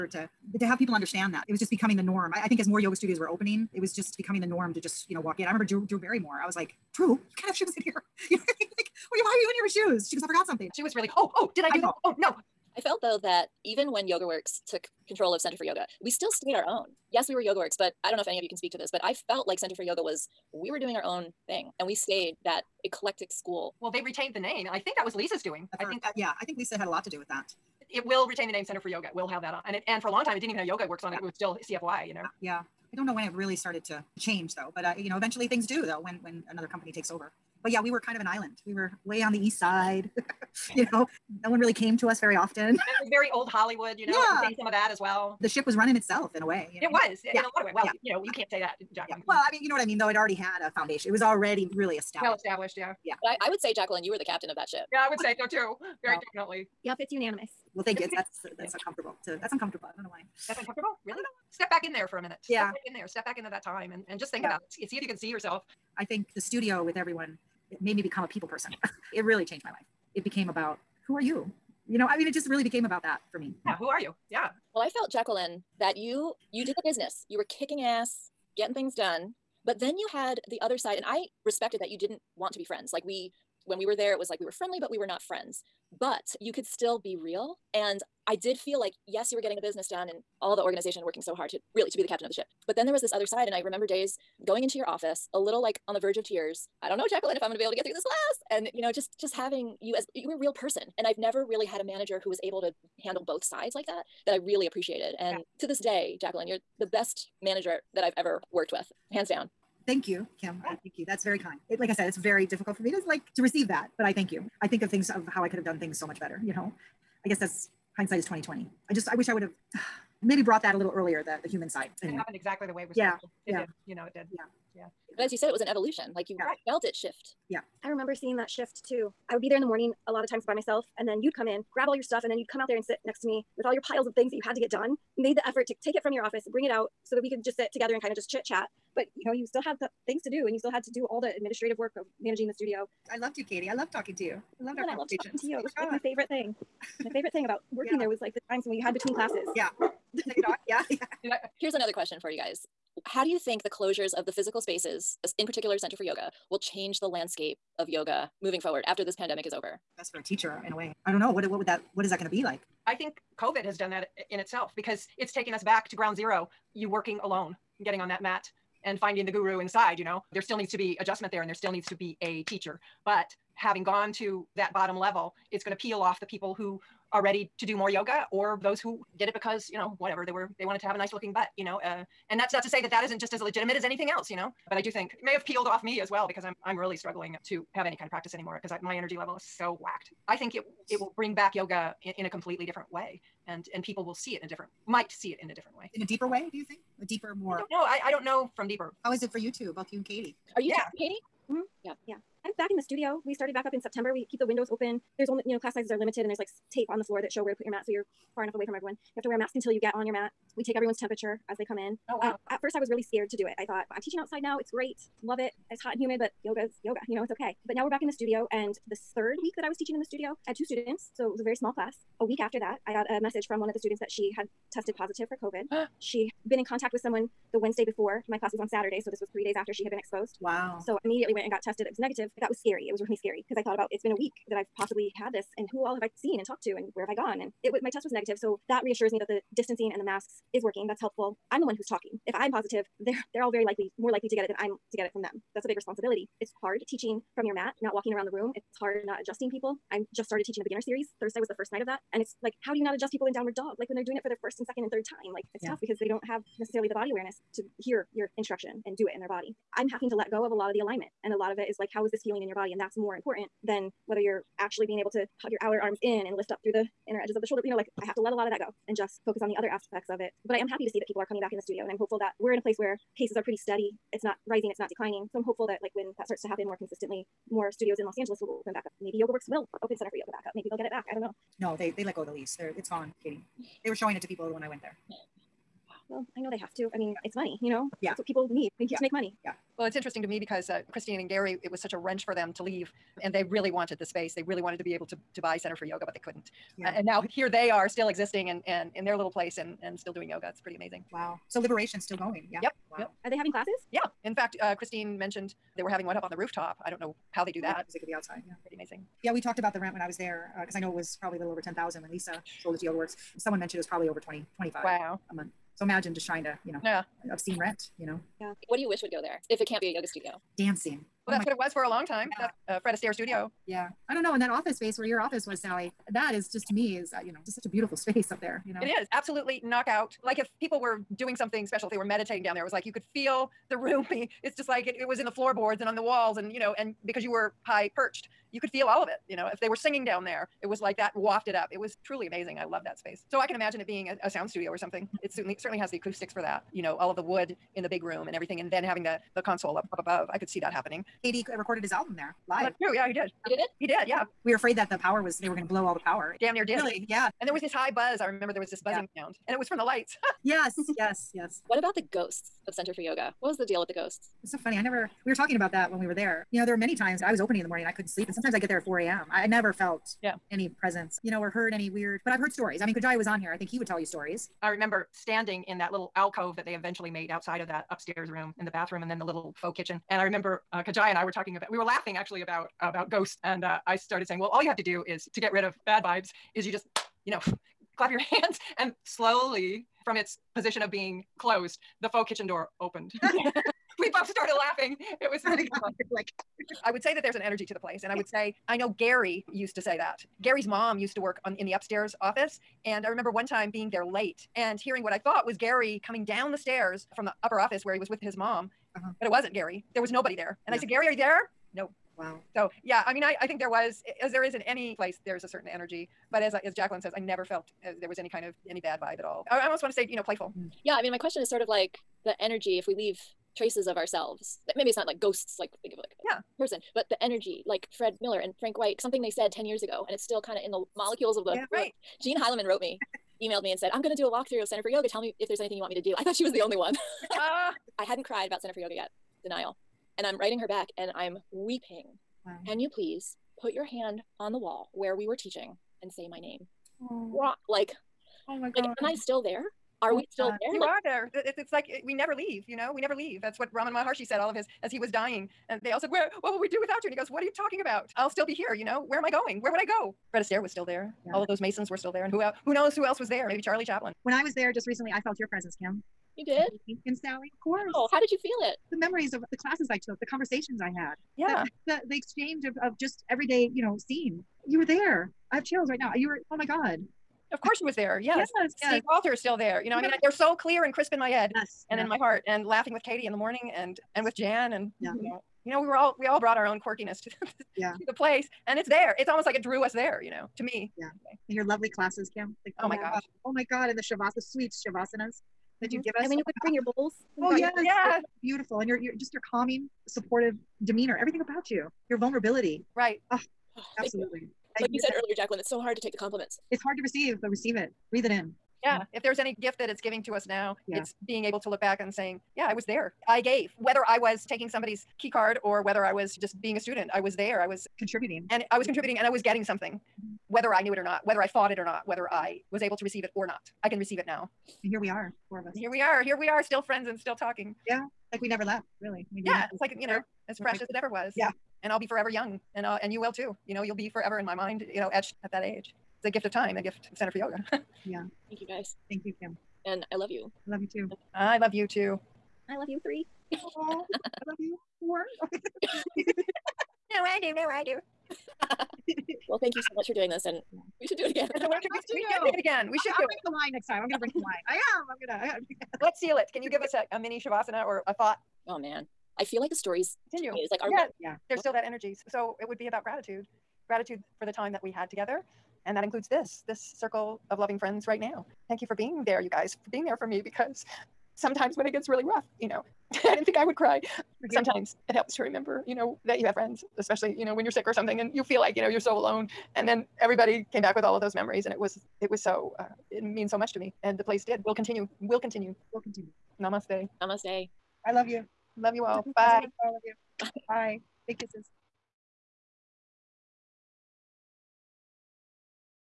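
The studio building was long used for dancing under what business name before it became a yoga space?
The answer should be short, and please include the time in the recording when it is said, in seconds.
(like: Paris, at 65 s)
Fred Astaire Studio, at 322 s.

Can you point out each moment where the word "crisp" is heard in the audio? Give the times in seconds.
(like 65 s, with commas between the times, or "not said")
480 s.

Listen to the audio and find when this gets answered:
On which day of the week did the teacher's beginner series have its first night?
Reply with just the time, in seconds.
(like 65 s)
251 s.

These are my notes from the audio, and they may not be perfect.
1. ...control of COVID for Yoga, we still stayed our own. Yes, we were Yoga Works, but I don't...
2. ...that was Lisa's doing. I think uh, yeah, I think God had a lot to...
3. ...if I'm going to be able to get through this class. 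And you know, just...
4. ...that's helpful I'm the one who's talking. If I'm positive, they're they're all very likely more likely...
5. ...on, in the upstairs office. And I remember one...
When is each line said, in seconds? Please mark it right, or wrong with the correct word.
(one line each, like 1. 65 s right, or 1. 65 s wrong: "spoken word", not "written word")
1. 15 s wrong: "Center", not "COVID"
2. 24 s wrong: "Lisa", not "God"
3. 97 s right
4. 240 s right
5. 401 s right.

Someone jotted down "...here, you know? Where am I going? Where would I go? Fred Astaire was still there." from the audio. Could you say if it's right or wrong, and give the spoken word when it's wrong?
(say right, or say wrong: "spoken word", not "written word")
right.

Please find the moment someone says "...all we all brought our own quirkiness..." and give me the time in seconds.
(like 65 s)
485 s.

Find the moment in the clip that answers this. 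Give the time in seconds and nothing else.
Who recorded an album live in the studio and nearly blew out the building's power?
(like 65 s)
351 s.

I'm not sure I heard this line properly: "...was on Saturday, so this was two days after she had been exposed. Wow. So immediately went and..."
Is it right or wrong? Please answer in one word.
wrong.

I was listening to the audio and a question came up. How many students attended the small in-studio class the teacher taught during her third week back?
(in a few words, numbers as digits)
2.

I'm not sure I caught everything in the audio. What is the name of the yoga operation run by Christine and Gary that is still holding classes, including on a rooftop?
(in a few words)
Liberation.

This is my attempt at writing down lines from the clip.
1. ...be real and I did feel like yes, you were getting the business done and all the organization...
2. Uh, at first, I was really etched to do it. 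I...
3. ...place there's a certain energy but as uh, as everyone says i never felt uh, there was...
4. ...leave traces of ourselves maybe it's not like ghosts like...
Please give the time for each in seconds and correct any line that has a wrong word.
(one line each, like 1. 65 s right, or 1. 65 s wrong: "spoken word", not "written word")
1. 86 s right
2. 212 s wrong: "scared", not "etched"
3. 414 s wrong: "jacqueline", not "everyone"
4. 422 s right.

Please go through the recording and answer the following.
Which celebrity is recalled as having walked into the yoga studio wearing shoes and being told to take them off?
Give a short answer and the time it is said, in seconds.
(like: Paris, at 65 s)
Drew Barrymore, at 5 s.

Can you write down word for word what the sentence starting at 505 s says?
earlier, Jacqueline, it's so hard to take the compliments.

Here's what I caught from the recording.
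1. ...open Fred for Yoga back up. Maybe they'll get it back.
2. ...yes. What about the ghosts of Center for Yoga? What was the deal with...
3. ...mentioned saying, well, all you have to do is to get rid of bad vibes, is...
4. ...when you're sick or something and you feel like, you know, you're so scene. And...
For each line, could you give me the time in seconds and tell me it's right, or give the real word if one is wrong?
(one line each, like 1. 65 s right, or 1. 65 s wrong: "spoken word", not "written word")
1. 279 s wrong: "Center", not "Fred"
2. 361 s right
3. 383 s wrong: "started", not "mentioned"
4. 577 s wrong: "alone", not "scene".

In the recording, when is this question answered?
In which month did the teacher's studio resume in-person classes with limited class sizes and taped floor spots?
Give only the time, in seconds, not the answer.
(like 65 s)
203 s.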